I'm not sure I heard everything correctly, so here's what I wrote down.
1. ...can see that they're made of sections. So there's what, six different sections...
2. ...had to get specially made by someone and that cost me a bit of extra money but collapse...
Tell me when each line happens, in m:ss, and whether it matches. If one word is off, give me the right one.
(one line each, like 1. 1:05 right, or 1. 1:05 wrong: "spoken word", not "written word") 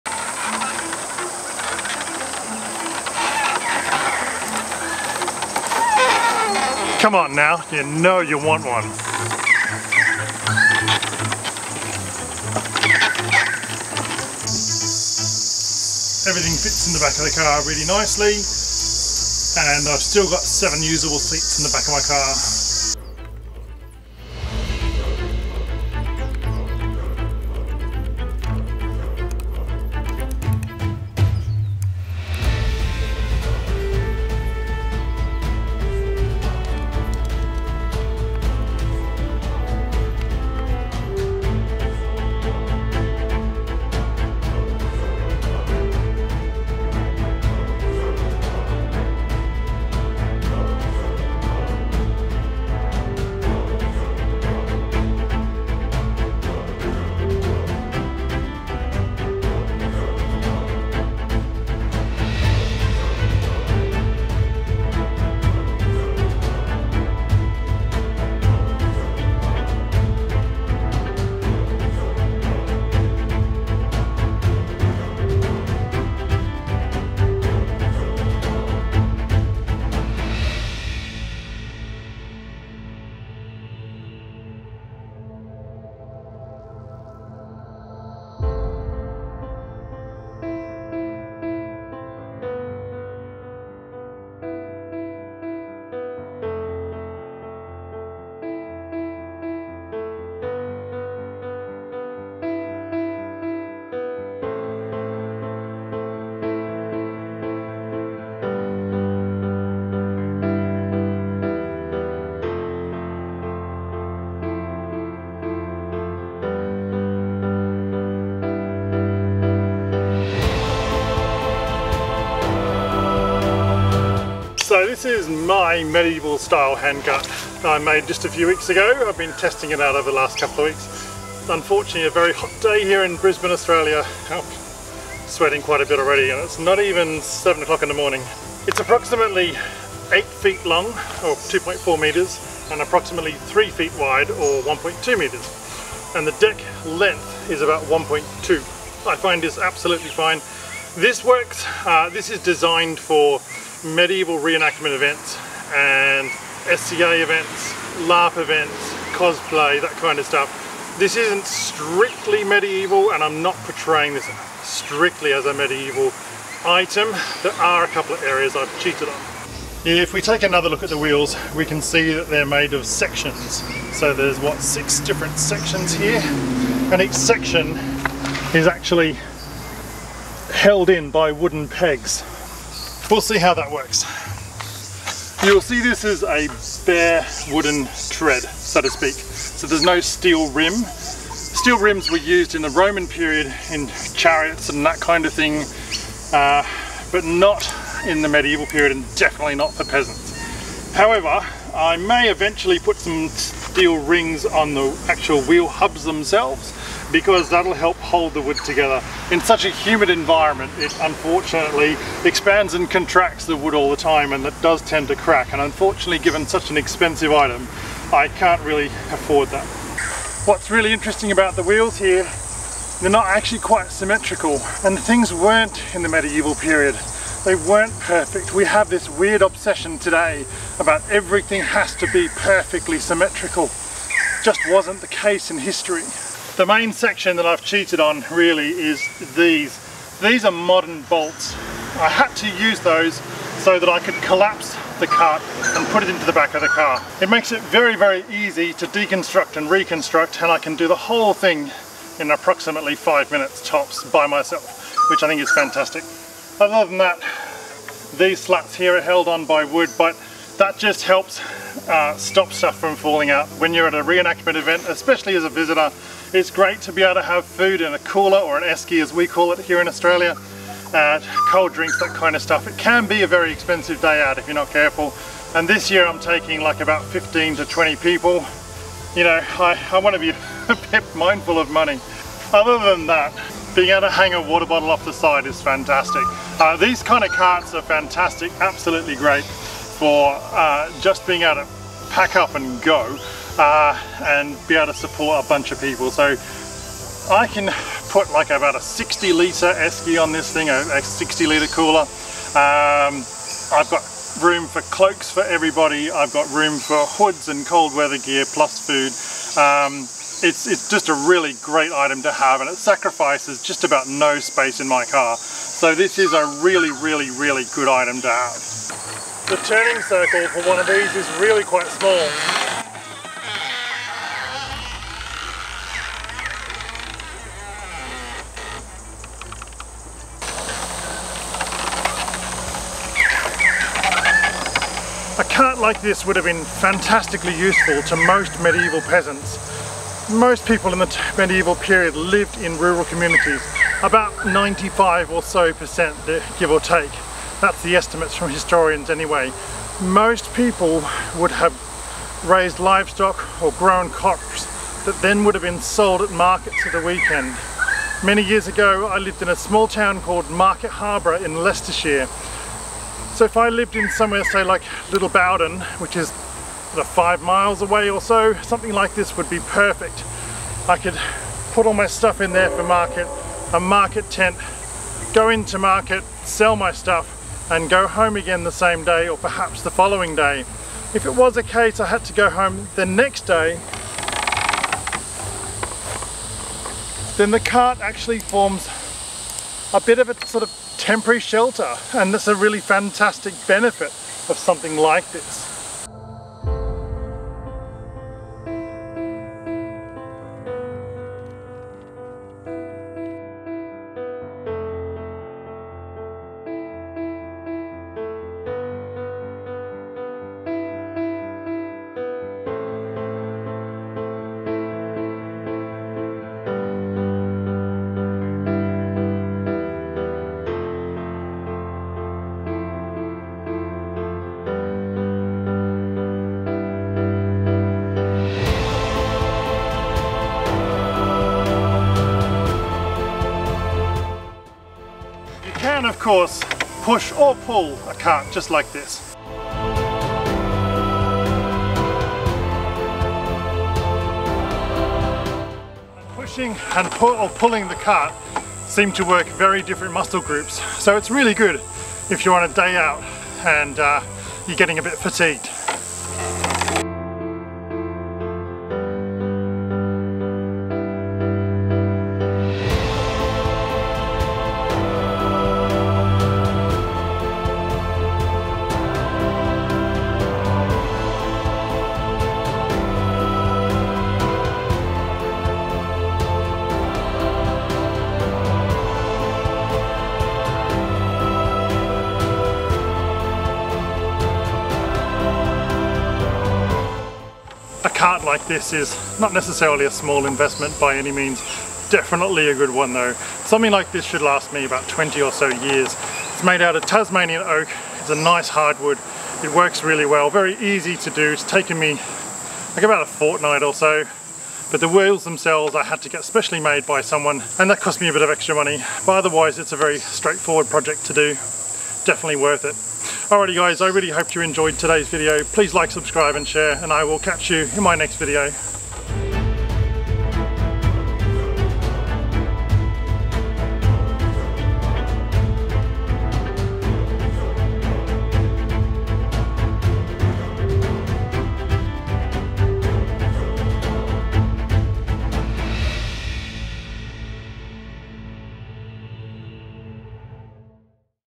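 1. 2:51 right
2. 8:26 wrong: "otherwise", not "collapse".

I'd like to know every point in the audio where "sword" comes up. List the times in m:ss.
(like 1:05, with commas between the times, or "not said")
not said.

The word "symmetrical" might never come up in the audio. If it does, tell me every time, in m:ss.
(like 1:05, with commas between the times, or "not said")
3:43, 3:52.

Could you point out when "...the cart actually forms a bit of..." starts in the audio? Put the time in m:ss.
6:27.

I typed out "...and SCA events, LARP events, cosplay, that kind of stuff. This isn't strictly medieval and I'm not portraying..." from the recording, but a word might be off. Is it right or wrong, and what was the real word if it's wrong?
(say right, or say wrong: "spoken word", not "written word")
right.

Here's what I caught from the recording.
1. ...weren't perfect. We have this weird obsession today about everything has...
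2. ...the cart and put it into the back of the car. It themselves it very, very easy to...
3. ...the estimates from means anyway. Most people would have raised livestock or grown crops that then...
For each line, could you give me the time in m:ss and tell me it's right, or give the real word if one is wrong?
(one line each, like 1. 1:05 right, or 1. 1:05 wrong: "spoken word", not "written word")
1. 3:47 right
2. 4:04 wrong: "makes", not "themselves"
3. 5:47 wrong: "historians", not "means".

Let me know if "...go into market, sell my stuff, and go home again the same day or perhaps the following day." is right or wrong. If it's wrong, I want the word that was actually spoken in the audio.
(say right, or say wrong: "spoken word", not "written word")
right.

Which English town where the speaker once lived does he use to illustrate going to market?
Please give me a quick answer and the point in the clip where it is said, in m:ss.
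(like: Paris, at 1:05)
Market Harborough, at 6:00.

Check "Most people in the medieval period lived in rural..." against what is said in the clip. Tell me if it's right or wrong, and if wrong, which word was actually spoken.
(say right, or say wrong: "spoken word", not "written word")
right.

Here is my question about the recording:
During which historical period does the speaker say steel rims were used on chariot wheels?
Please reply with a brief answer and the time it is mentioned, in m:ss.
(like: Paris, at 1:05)
Roman period, at 3:12.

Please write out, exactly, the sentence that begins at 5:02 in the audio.
Um, I've got room for cloaks for everybody.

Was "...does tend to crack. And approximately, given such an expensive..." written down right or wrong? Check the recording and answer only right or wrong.
wrong.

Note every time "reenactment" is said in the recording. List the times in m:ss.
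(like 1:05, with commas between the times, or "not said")
2:34, 4:24.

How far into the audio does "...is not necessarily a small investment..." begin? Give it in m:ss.
8:08.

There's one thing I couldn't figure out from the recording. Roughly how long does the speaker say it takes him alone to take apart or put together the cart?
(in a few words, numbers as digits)
5 minutes.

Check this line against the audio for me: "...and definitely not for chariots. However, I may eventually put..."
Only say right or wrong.
wrong.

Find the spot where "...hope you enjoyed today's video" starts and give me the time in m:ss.
8:34.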